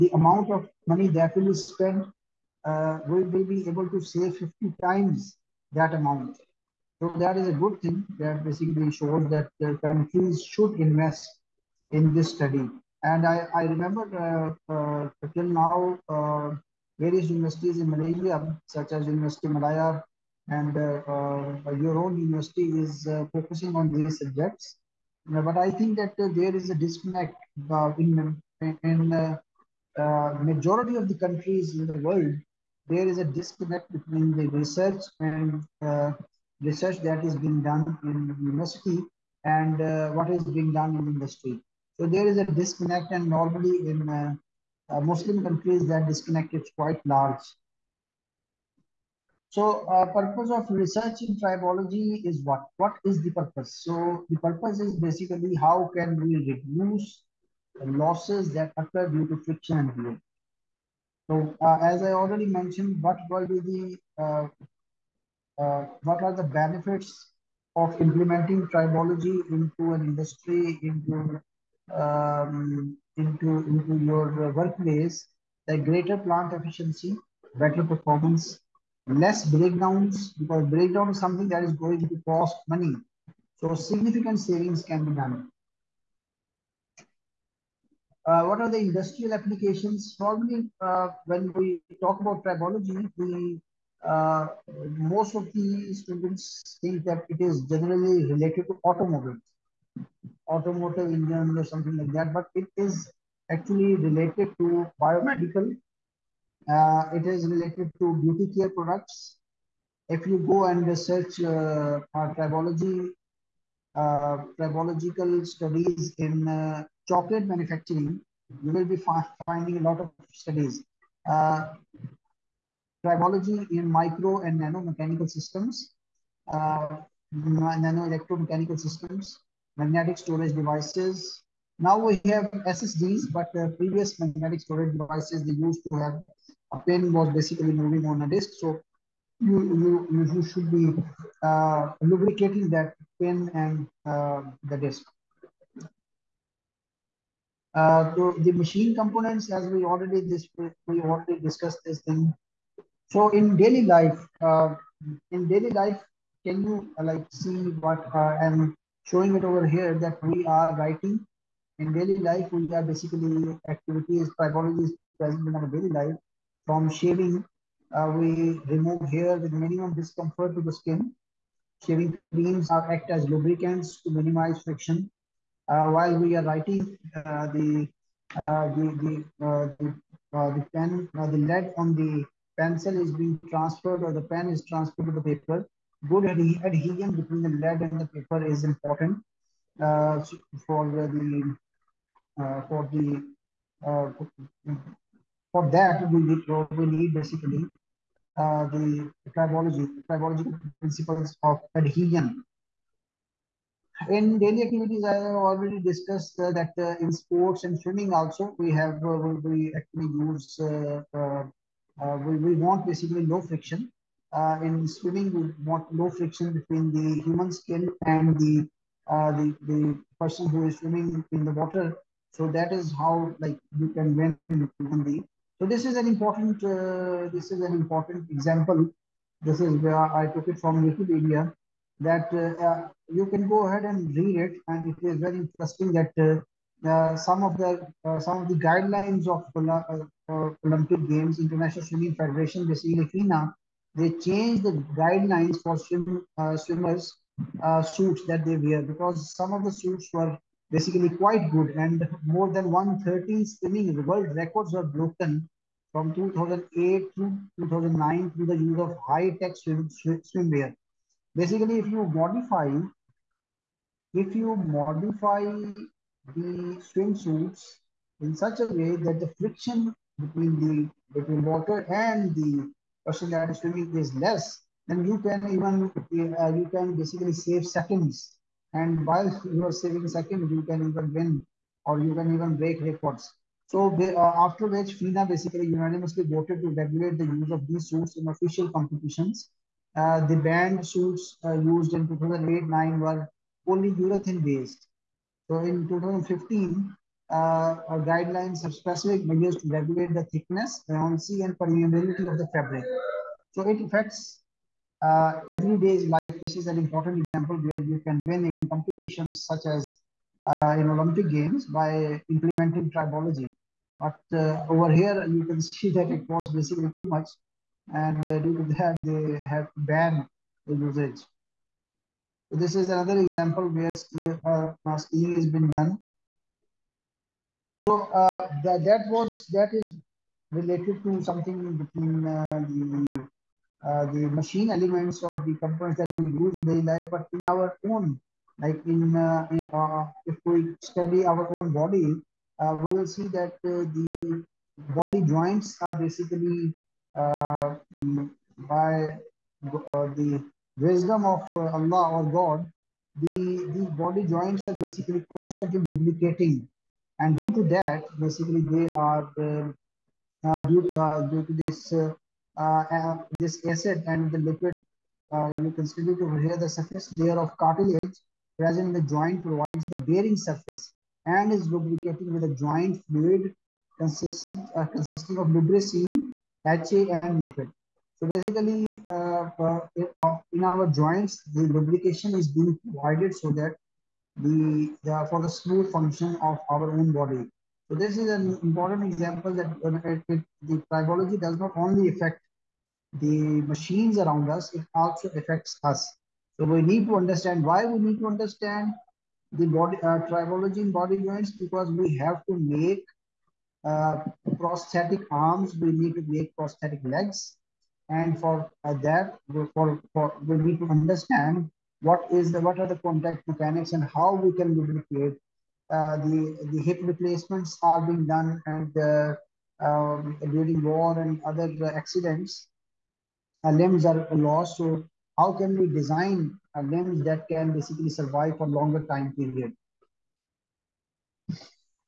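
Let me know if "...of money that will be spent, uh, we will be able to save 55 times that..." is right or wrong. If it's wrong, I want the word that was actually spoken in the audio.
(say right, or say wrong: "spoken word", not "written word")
wrong: "50", not "55".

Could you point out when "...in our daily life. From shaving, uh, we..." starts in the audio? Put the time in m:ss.
2:45.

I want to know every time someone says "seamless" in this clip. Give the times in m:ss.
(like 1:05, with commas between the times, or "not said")
not said.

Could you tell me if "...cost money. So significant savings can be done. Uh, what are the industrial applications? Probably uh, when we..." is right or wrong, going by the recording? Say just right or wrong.
right.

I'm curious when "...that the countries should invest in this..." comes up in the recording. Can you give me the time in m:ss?
0:09.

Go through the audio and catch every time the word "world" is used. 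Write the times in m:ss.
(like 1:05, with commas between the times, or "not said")
0:32, 4:14.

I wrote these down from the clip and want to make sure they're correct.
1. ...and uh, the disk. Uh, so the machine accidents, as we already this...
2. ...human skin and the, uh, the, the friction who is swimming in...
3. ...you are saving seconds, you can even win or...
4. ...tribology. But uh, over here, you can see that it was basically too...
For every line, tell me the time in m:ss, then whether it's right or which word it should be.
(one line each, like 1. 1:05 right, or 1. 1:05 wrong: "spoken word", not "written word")
1. 2:23 wrong: "components", not "accidents"
2. 3:37 wrong: "person", not "friction"
3. 4:39 right
4. 5:12 right.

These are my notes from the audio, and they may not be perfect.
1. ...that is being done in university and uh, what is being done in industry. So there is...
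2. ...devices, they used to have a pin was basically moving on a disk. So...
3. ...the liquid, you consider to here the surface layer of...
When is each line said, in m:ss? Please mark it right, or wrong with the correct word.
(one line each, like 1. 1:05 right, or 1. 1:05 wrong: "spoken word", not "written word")
1. 0:36 right
2. 2:14 right
3. 6:04 right.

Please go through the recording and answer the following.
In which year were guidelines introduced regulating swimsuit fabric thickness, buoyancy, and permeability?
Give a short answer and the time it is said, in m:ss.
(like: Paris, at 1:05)
2015, at 4:55.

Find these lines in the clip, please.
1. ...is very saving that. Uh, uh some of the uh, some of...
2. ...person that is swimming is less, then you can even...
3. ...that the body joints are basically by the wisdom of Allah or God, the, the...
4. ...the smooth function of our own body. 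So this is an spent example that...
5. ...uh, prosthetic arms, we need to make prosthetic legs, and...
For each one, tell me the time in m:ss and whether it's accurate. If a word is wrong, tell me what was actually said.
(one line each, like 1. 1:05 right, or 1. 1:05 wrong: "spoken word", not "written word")
1. 3:55 wrong: "interesting", not "saving"
2. 4:33 right
3. 5:43 right
4. 6:25 wrong: "important", not "spent"
5. 6:43 right.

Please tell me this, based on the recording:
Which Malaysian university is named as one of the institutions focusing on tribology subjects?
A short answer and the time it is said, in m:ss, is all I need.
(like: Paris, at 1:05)
University Malaya, at 0:19.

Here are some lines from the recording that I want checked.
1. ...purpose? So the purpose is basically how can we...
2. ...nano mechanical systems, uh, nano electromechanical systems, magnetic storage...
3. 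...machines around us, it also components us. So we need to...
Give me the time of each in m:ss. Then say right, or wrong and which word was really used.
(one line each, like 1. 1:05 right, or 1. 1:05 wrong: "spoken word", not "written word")
1. 0:53 right
2. 2:04 right
3. 6:33 wrong: "affects", not "components".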